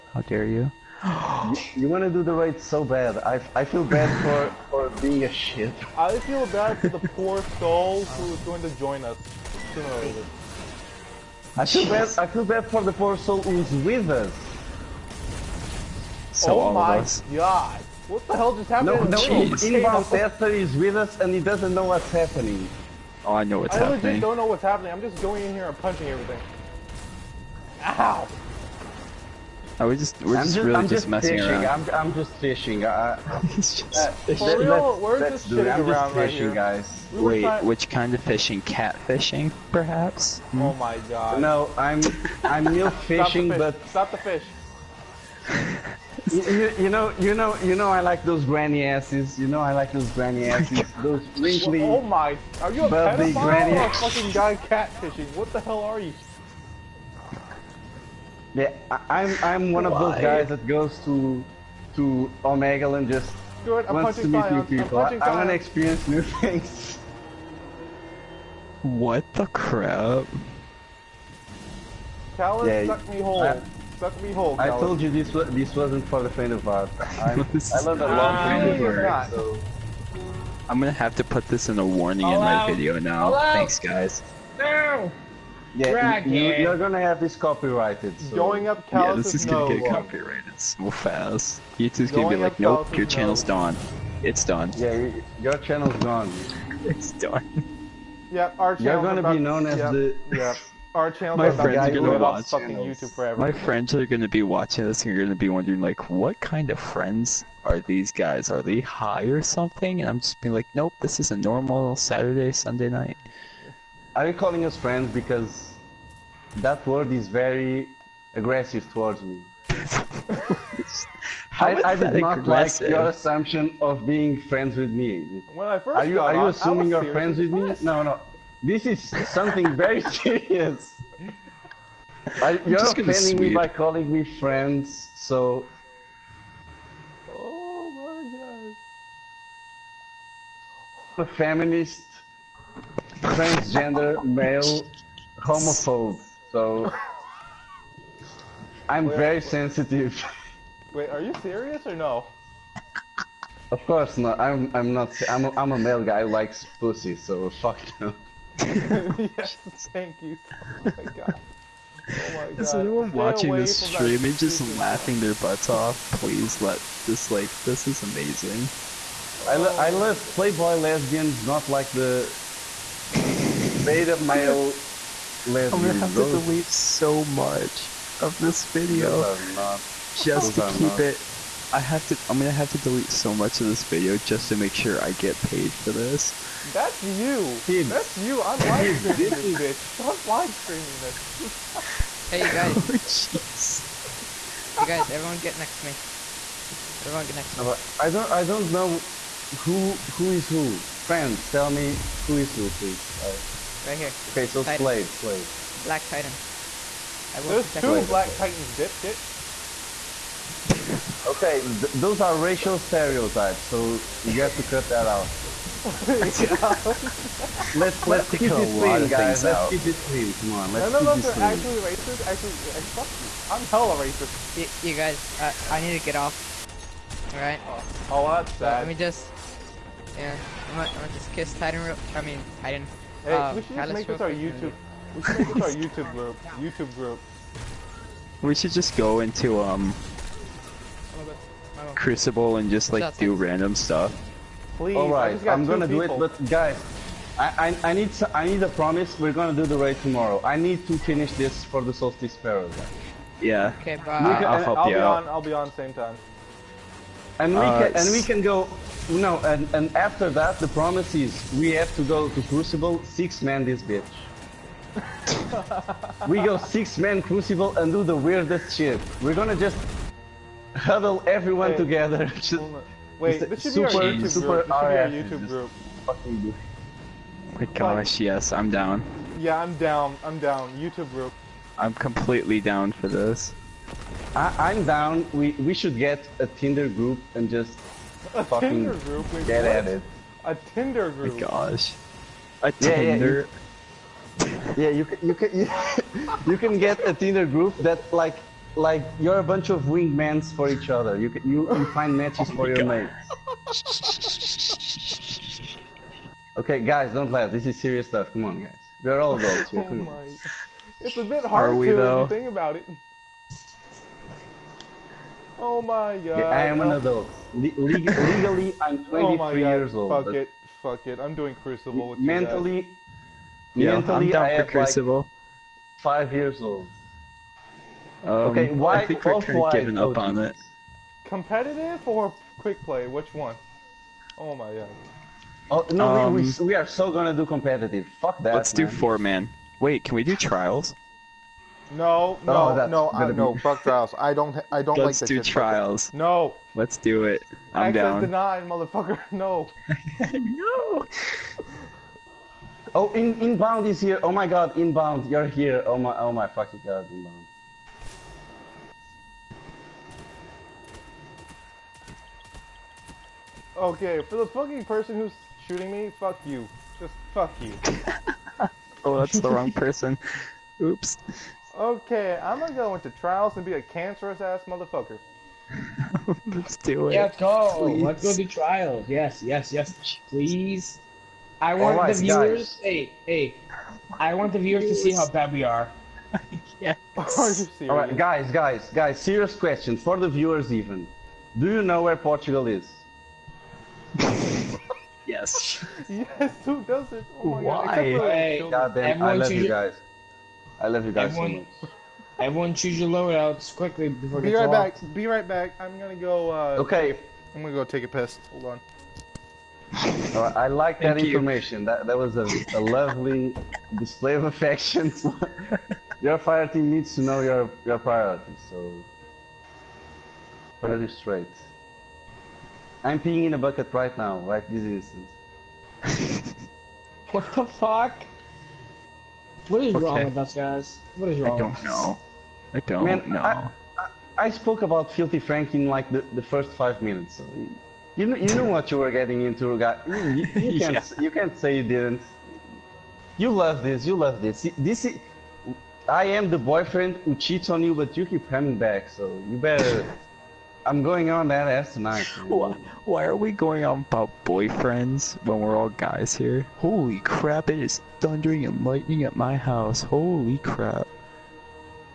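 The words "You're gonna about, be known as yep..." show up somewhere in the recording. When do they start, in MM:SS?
01:38.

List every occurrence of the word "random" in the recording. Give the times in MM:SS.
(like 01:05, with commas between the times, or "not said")
04:03.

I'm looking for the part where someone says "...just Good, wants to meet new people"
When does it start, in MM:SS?
01:03.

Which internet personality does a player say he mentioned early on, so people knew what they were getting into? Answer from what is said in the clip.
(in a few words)
Filthy Frank.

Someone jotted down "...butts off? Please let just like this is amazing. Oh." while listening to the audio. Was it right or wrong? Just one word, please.
right.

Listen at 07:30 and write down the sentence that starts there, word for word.
I'm going on that ass tonight.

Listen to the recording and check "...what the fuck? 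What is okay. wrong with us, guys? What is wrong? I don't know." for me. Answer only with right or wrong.
right.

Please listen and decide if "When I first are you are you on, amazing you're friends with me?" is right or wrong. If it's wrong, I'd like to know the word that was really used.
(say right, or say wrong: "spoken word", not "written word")
wrong: "assuming", not "amazing".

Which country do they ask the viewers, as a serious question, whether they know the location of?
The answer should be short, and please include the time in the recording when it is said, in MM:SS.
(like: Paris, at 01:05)
Portugal, at 06:32.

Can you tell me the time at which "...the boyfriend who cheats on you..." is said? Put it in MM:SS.
07:26.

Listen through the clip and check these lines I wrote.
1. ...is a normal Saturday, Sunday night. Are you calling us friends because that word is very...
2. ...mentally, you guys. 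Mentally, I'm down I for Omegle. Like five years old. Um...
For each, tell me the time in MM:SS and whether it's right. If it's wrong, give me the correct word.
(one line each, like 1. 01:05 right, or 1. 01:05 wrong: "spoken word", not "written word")
1. 01:51 right
2. 05:22 wrong: "Crucible", not "Omegle".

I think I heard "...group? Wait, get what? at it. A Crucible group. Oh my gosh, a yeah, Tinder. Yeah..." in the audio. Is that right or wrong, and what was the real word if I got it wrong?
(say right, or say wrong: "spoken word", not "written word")
wrong: "Tinder", not "Crucible".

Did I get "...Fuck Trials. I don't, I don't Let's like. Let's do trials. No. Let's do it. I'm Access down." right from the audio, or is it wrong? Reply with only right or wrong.
right.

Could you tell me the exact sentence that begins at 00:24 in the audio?
I'm just going in here and punching everything.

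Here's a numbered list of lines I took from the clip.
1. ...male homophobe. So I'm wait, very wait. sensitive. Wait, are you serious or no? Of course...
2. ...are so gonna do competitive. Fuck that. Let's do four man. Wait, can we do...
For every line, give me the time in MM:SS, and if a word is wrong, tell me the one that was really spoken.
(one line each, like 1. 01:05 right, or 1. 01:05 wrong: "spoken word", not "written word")
1. 02:24 right
2. 05:36 right.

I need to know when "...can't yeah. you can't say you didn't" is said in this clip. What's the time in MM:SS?
07:20.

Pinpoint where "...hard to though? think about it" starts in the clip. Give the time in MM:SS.
05:11.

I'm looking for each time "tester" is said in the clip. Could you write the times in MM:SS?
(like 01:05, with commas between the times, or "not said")
00:20.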